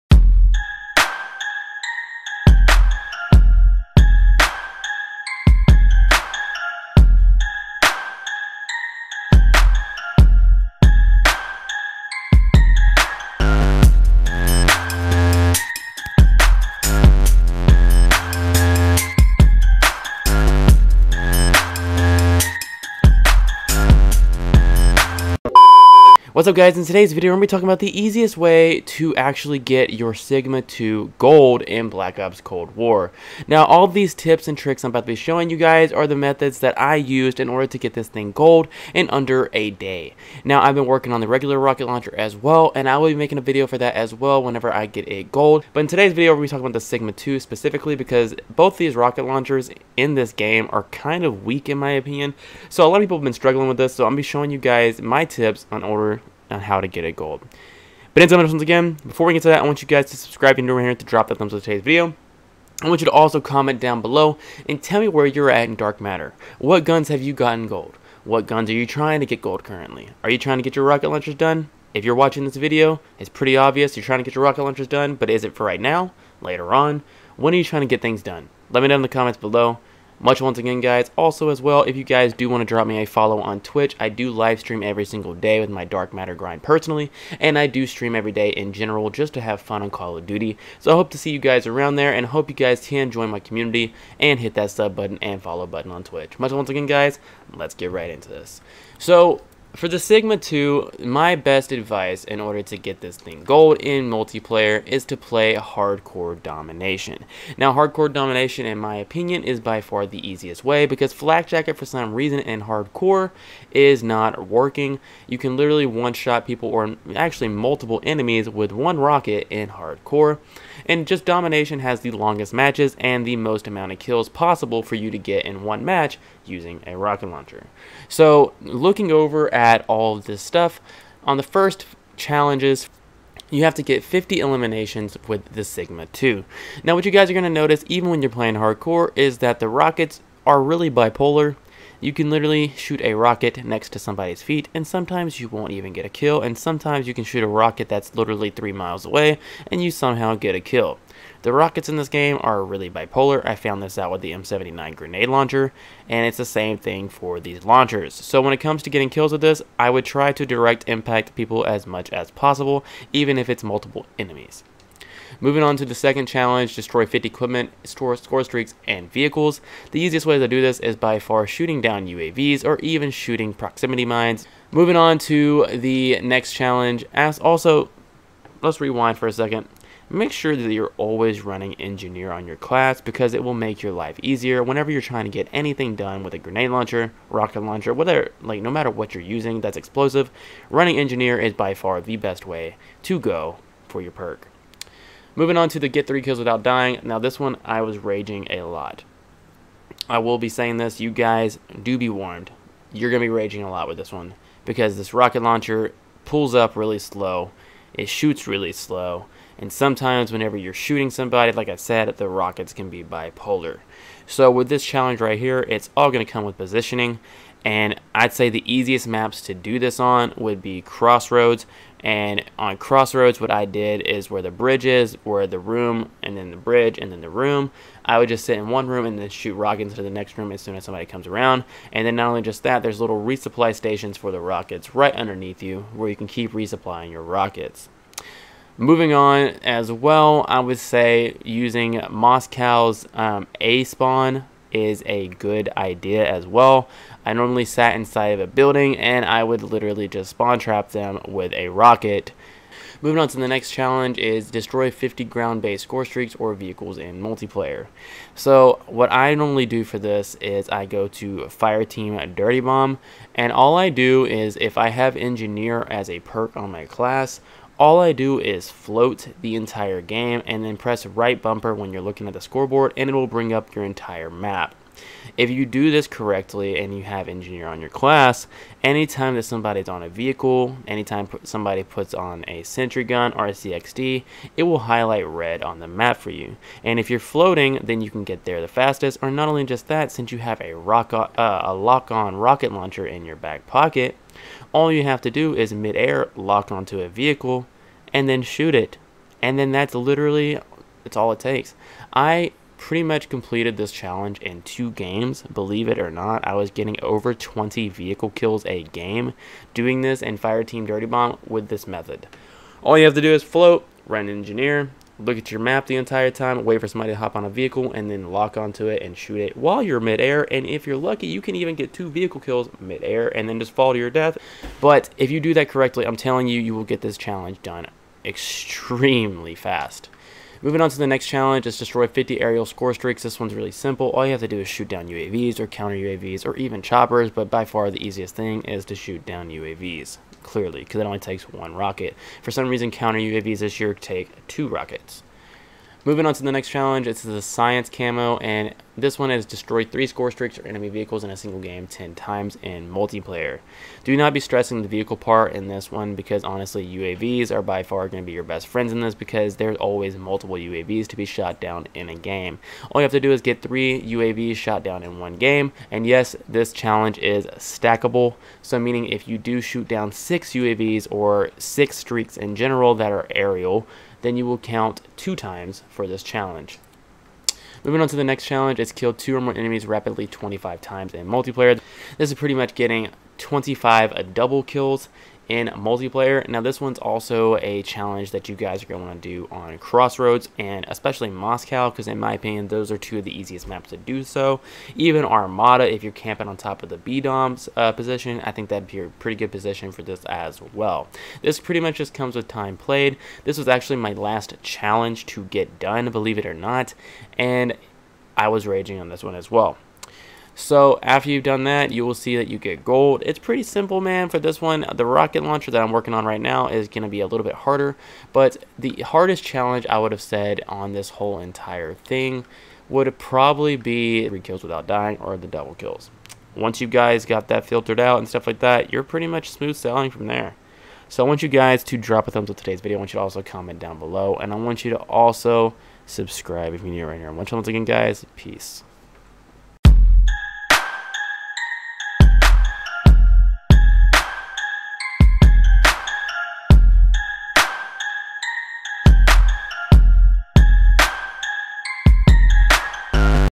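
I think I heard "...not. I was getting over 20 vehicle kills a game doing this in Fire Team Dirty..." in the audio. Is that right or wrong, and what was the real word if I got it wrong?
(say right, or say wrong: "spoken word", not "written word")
right.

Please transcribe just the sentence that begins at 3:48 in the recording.
I would just sit in one room and then shoot rockets into the next room as soon as somebody comes around.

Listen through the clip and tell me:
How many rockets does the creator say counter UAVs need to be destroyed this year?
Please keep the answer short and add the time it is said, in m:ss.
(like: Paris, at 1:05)
2, at 5:44.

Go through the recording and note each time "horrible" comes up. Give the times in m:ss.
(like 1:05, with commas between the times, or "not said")
not said.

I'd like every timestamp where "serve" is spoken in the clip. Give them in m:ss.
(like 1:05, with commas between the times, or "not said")
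not said.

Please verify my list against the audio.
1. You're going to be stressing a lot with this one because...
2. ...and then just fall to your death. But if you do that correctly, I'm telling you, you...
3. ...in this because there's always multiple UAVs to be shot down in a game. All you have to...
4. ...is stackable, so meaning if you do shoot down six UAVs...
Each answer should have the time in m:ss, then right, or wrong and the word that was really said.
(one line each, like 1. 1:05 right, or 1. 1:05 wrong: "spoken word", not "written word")
1. 3:22 wrong: "raging", not "stressing"
2. 5:23 right
3. 5:58 right
4. 6:07 right.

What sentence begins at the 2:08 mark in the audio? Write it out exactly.
So looking over at all of this stuff, on the first challenges, you have to get 50 eliminations with the Cigma 2.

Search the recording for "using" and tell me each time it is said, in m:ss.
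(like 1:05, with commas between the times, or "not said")
2:06, 3:09, 4:01.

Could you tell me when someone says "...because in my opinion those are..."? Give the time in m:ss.
6:31.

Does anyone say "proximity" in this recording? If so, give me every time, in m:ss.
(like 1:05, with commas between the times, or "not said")
2:53.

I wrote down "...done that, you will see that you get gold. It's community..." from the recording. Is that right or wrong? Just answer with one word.
wrong.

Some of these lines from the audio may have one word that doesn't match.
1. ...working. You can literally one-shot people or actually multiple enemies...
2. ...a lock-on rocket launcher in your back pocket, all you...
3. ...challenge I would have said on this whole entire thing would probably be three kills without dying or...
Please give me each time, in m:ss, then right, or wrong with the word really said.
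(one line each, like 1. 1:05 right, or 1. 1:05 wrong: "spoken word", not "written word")
1. 1:54 right
2. 4:51 right
3. 6:59 right.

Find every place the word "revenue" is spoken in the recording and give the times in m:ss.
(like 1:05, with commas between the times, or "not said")
not said.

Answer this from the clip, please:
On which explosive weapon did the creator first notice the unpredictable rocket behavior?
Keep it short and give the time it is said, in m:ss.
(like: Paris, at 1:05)
M79 grenade launcher, at 2:34.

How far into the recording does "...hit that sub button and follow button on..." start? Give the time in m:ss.
1:34.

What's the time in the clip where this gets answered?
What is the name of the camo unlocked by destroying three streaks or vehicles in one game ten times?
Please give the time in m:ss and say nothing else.
5:47.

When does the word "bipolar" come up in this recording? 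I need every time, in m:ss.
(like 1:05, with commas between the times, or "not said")
2:20, 2:32, 3:33.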